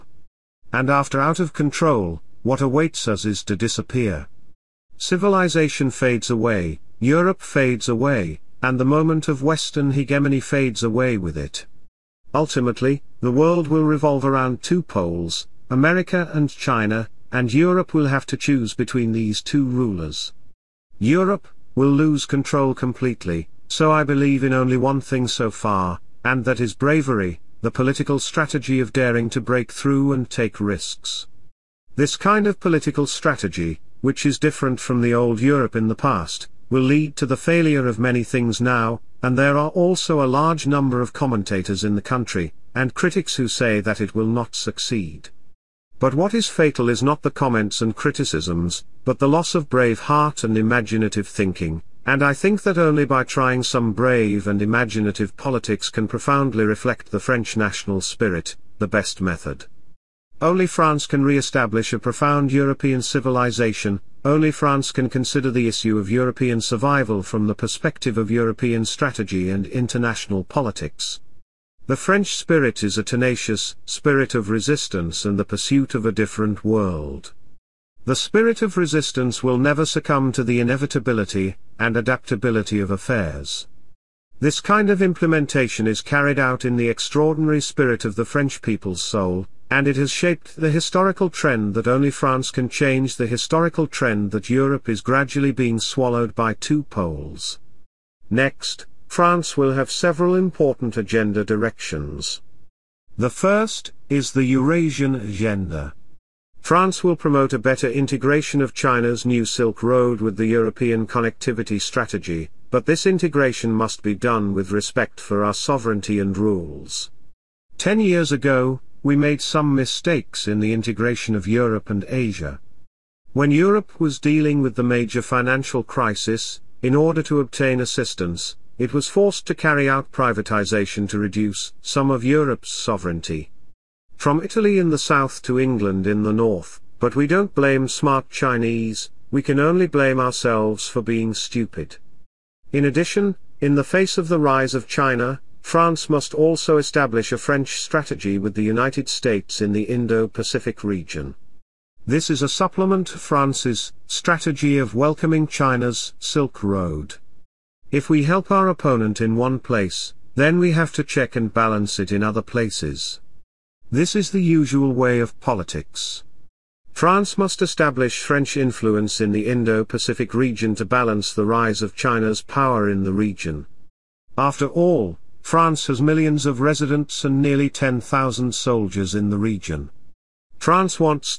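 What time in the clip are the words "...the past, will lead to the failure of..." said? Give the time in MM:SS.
00:35.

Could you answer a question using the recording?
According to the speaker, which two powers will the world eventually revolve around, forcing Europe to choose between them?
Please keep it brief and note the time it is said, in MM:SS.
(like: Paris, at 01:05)
America and China, at 00:15.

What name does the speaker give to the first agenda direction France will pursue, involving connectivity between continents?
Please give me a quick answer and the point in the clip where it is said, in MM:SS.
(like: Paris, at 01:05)
Eurasian agenda, at 01:44.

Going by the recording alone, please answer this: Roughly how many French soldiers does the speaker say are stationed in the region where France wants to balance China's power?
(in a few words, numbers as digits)
nearly 10,000.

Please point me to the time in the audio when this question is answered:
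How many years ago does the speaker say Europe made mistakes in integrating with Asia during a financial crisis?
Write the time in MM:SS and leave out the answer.
01:57.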